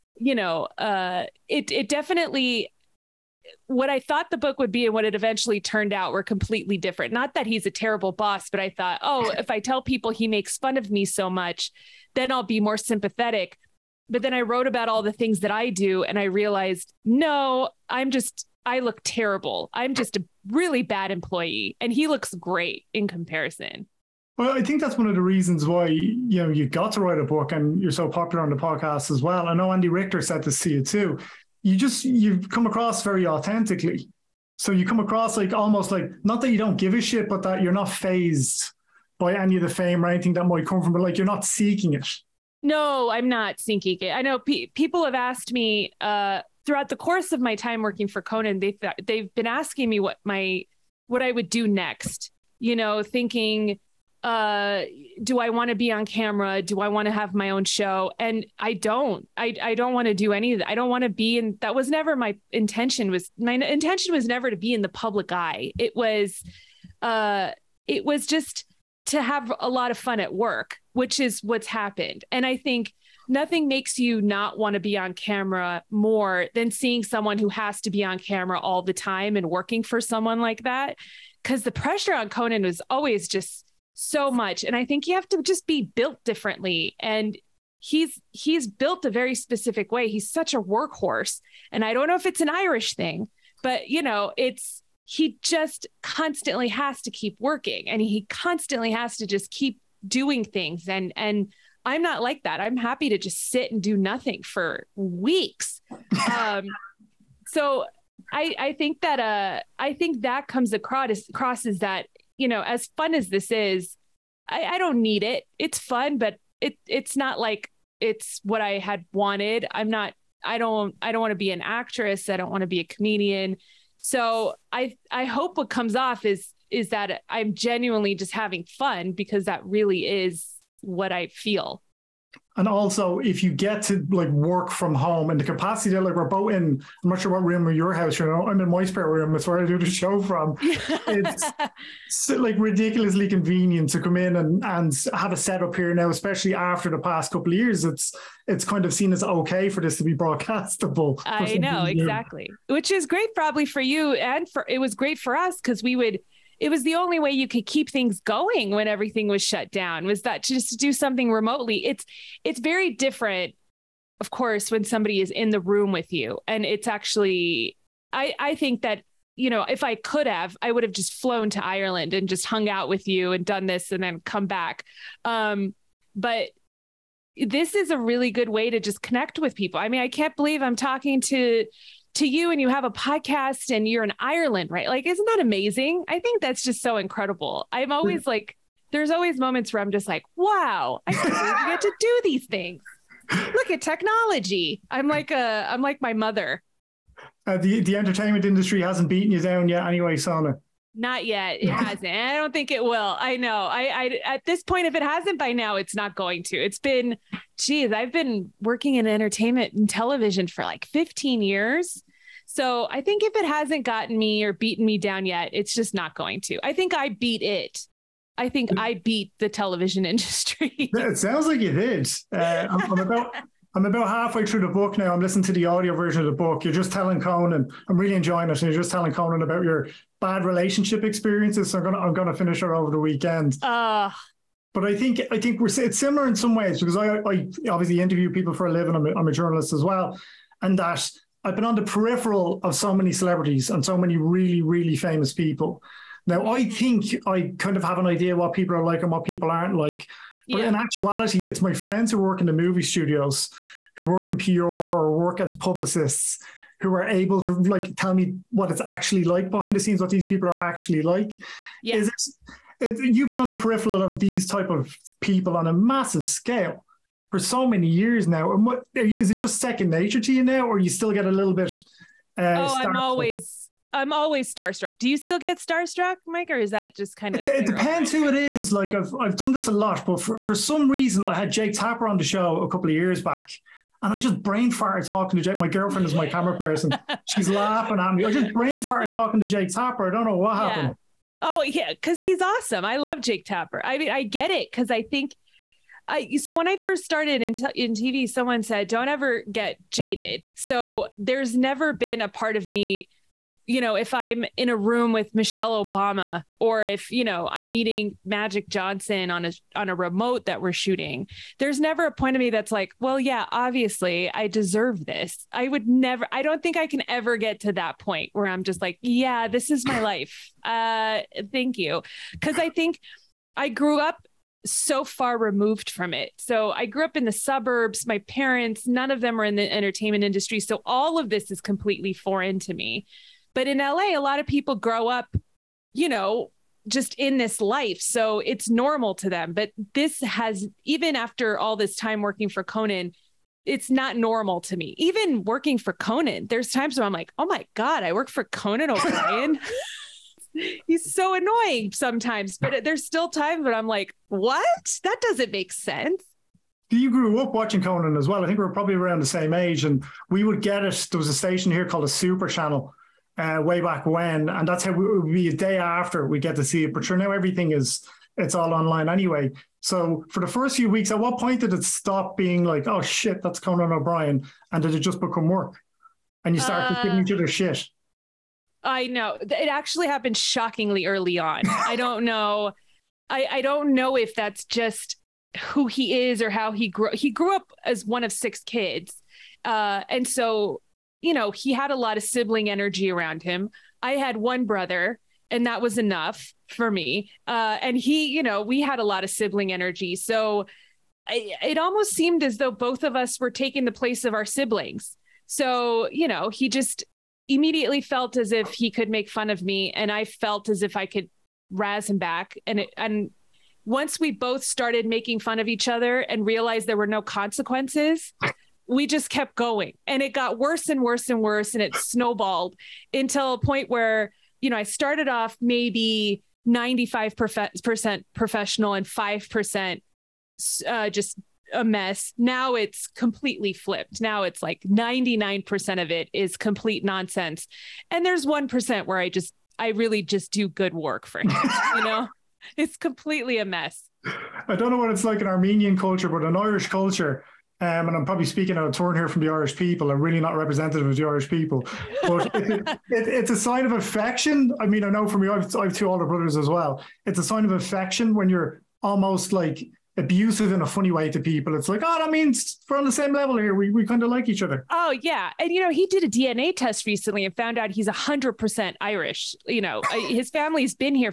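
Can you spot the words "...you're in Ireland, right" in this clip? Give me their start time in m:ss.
3:03.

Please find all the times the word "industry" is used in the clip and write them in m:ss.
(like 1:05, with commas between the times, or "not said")
3:18, 3:40, 5:30.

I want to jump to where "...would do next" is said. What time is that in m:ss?
0:51.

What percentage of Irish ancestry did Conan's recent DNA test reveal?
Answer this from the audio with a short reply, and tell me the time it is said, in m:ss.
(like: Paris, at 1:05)
100%, at 7:48.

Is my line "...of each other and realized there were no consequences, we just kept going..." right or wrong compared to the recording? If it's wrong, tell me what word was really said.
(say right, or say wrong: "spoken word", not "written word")
right.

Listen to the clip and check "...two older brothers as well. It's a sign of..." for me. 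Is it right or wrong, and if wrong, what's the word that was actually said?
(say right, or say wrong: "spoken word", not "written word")
right.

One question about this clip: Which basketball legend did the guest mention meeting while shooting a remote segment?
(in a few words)
Magic Johnson.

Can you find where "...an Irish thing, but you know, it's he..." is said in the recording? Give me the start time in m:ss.
1:32.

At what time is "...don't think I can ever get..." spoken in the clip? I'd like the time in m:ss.
5:16.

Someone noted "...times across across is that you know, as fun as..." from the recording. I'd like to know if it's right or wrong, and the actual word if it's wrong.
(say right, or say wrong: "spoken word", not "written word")
wrong: "comes", not "times".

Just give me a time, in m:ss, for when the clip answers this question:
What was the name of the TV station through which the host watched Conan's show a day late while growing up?
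6:02.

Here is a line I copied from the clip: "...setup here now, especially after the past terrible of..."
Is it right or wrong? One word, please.
wrong.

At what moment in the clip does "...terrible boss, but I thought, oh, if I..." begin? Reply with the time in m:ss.
0:07.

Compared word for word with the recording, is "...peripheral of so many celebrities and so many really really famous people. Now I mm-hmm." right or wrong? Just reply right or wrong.
right.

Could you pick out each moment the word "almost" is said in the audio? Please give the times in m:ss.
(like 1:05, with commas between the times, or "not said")
0:35, 6:41, 7:39.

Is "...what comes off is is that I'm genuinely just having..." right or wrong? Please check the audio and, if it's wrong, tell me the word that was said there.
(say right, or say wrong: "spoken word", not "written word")
right.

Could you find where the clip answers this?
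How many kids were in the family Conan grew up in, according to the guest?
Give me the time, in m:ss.
6:28.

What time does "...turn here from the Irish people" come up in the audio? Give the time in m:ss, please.
7:28.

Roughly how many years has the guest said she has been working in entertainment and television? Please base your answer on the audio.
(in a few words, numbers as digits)
15.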